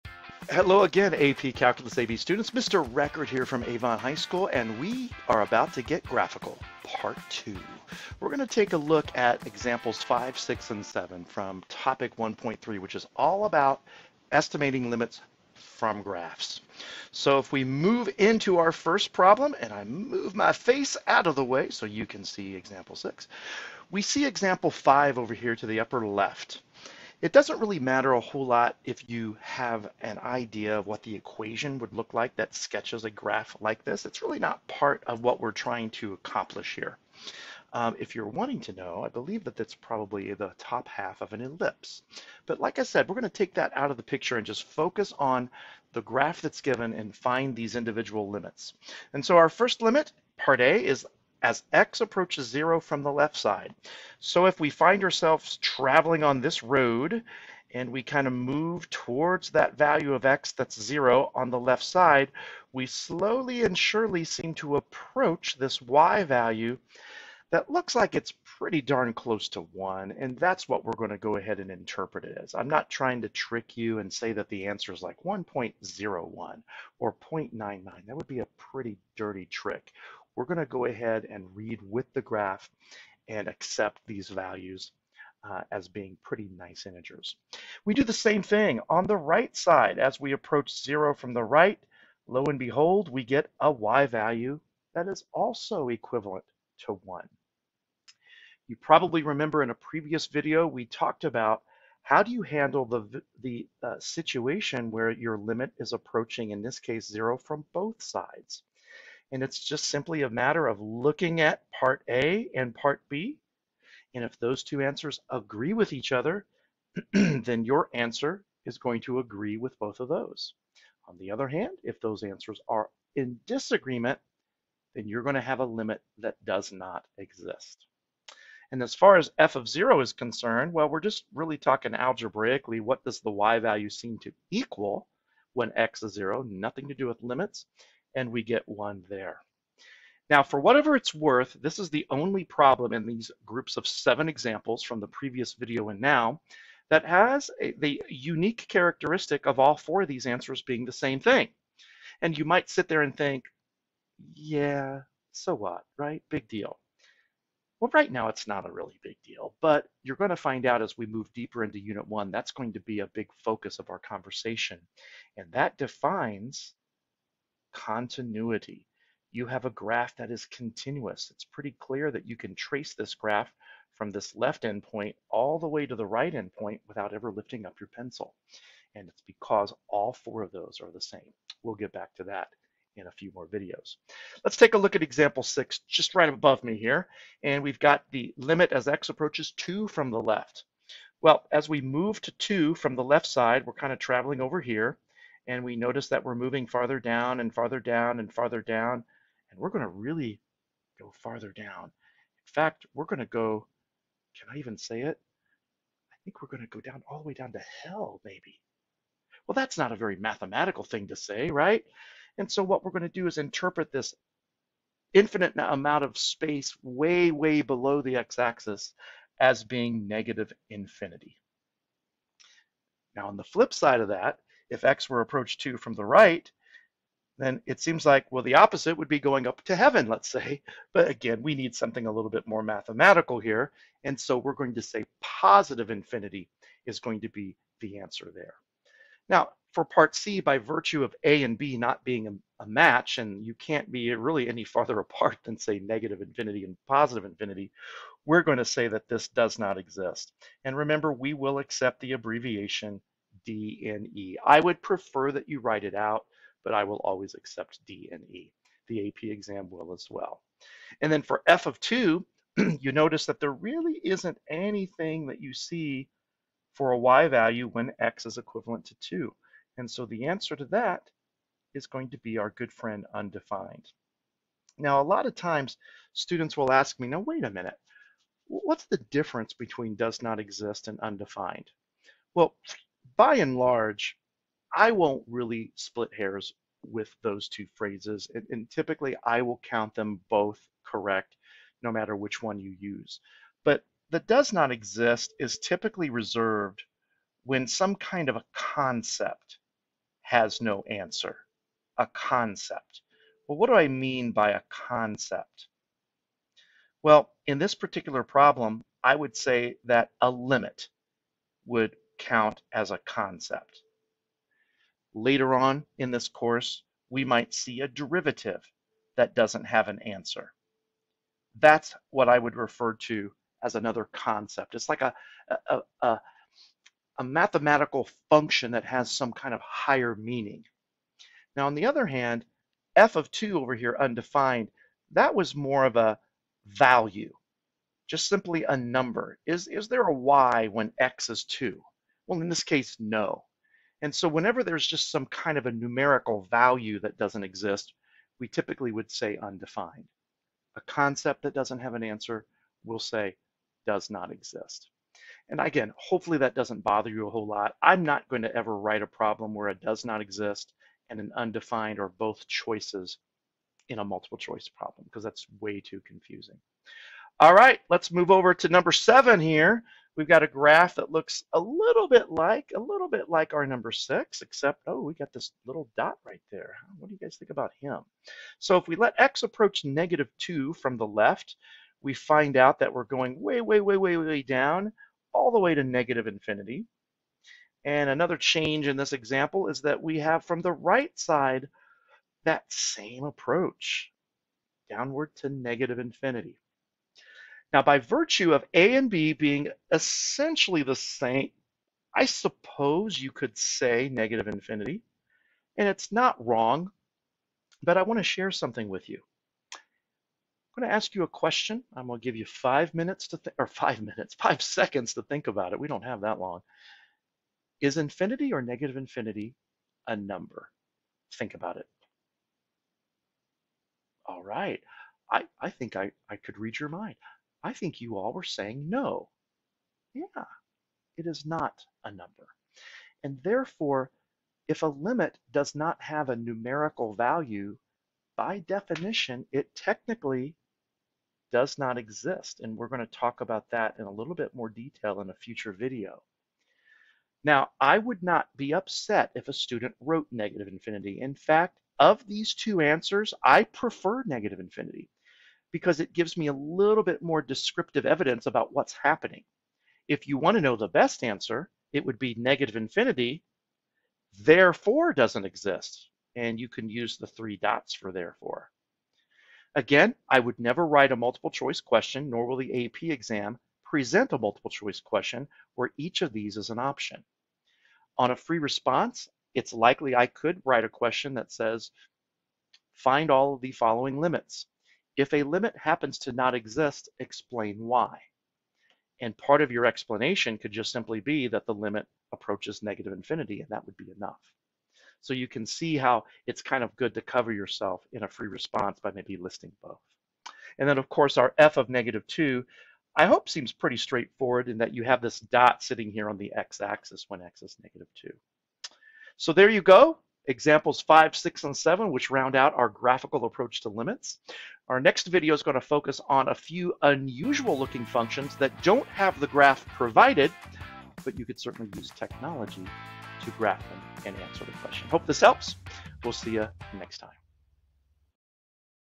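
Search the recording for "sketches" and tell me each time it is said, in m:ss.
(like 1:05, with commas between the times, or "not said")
0:32.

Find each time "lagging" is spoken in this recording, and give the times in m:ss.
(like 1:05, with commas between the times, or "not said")
not said.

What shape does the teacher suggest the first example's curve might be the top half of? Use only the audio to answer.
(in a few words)
An ellipse.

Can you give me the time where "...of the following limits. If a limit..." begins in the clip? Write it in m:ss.
8:03.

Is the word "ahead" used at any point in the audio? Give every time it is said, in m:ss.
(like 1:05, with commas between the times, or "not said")
1:11, 1:20.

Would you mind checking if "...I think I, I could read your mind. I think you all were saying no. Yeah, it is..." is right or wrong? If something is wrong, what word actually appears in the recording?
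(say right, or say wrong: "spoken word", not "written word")
right.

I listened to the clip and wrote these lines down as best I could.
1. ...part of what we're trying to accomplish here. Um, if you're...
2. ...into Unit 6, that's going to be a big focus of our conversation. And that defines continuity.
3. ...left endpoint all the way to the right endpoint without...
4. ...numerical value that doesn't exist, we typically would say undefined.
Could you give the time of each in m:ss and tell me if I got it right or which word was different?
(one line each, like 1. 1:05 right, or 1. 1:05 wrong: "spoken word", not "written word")
1. 0:34 right
2. 2:41 wrong: "1", not "6"
3. 2:54 right
4. 5:45 right.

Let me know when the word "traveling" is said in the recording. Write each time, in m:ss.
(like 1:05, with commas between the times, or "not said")
0:55, 3:13.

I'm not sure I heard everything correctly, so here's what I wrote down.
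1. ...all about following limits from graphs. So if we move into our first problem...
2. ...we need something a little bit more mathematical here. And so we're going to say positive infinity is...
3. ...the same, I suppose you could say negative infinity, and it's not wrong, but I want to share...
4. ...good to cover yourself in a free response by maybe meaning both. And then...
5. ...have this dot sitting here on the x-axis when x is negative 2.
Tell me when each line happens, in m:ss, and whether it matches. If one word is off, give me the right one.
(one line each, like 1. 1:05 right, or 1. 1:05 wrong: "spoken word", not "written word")
1. 0:13 wrong: "estimating", not "following"
2. 3:51 right
3. 6:40 right
4. 8:16 wrong: "listing", not "meaning"
5. 8:25 right.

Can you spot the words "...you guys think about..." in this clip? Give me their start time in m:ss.
6:17.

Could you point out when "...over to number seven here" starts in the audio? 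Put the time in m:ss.
6:08.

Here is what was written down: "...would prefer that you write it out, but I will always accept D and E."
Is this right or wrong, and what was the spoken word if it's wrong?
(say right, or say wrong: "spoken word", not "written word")
right.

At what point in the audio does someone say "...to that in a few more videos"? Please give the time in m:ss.
3:02.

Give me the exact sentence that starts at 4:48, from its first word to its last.
And, and, typically I will count them both correct, no matter which one you use.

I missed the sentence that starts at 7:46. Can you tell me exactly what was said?
And you can use the three dots for therefore.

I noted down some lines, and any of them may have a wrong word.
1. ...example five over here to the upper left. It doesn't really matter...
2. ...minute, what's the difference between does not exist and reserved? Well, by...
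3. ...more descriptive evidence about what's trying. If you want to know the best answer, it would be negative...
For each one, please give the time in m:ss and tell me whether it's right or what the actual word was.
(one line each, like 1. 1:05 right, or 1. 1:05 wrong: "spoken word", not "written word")
1. 0:24 right
2. 4:37 wrong: "undefined", not "reserved"
3. 7:37 wrong: "happening", not "trying".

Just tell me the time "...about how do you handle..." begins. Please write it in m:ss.
1:41.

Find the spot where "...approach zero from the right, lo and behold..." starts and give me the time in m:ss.
1:30.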